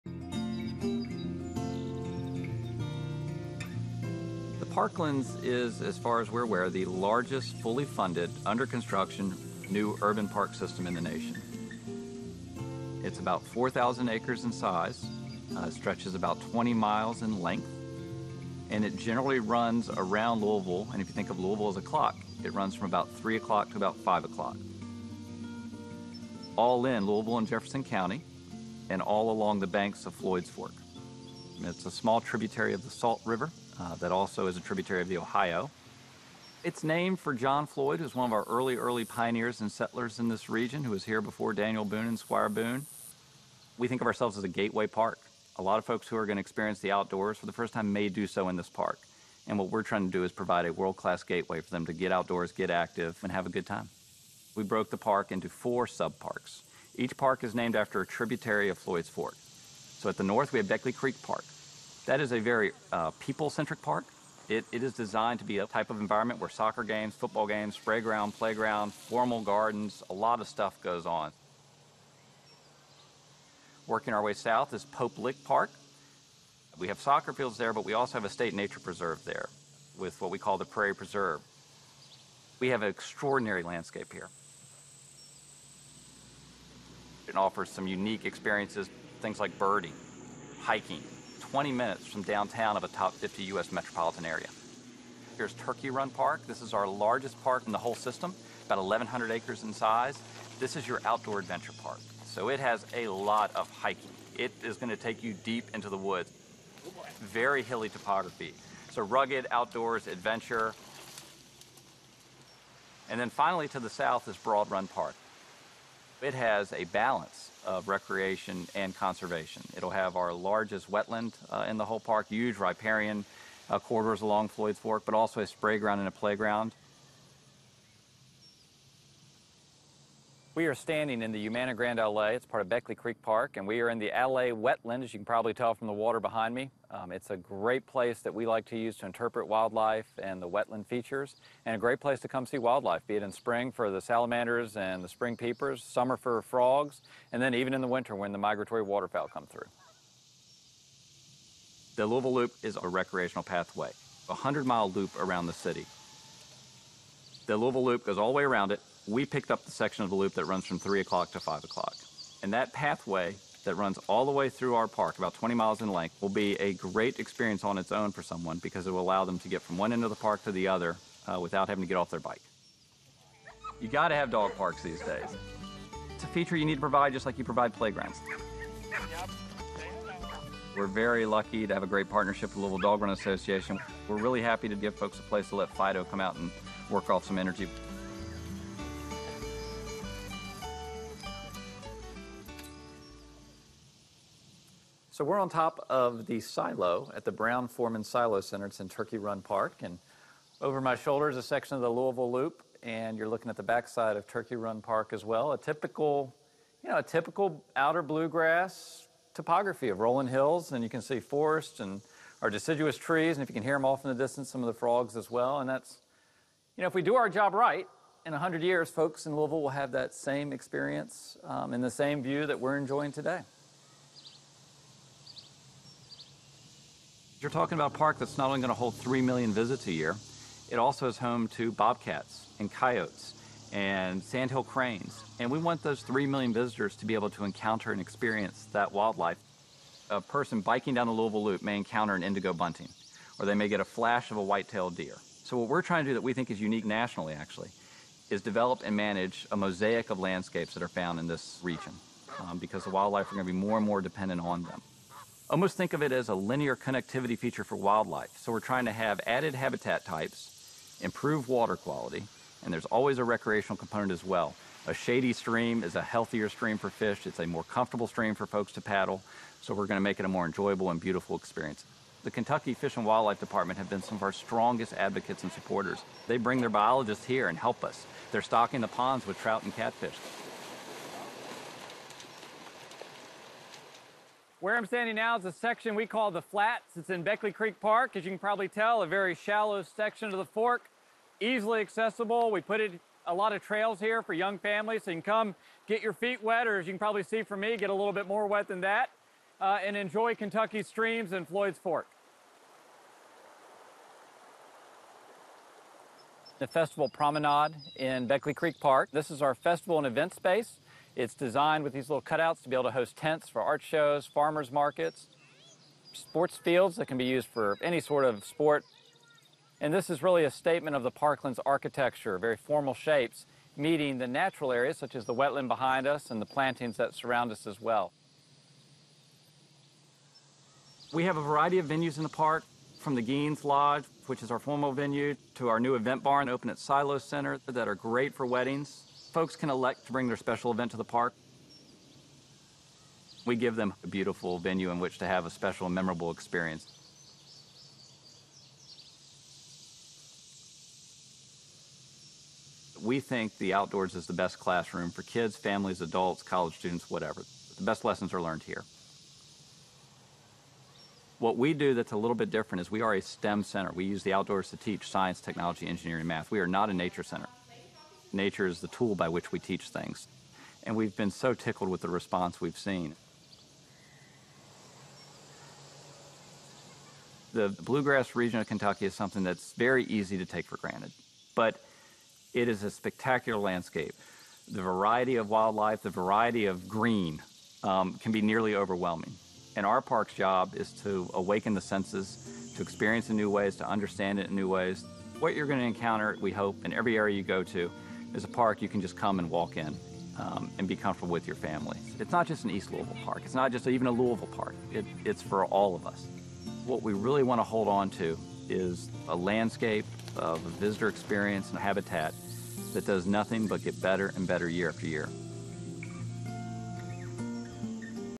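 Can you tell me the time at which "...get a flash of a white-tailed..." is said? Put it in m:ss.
4:03.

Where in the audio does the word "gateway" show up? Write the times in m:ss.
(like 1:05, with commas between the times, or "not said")
0:44, 0:51.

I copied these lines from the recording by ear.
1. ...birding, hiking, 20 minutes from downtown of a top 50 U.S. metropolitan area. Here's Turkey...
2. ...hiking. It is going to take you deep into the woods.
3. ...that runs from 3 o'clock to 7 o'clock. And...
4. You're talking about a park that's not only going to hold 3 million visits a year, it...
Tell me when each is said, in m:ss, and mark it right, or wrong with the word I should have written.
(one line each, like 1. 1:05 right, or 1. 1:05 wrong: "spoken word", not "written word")
1. 1:29 right
2. 1:43 right
3. 2:40 wrong: "5", not "7"
4. 3:47 right.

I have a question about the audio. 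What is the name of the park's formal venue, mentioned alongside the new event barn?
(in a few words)
Gheens Lodge.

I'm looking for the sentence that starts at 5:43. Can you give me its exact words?
We give them a beautiful venue in which to have a special and memorable experience.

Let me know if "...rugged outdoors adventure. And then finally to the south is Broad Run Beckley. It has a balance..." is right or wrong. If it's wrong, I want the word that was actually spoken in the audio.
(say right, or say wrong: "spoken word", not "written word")
wrong: "Park", not "Beckley".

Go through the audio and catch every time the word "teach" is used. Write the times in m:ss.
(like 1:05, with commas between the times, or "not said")
6:04, 6:09.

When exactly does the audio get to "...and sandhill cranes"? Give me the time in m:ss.
3:53.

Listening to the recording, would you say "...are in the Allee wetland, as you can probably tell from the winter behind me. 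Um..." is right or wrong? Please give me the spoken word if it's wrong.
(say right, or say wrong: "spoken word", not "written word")
wrong: "water", not "winter".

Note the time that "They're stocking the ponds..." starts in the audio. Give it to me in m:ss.
4:38.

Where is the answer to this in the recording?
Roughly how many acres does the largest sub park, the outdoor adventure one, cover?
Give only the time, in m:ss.
1:38.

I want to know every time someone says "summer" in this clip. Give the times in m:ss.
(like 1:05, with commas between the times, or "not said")
2:25.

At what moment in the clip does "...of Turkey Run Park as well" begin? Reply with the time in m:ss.
3:24.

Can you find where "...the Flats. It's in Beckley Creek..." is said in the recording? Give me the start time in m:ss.
4:46.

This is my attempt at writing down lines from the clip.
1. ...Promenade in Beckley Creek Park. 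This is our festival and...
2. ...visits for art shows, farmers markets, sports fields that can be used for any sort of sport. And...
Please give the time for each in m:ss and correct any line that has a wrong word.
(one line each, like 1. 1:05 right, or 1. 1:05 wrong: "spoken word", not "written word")
1. 5:07 right
2. 5:13 wrong: "tents", not "visits".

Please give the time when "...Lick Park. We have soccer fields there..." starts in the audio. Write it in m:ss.
1:15.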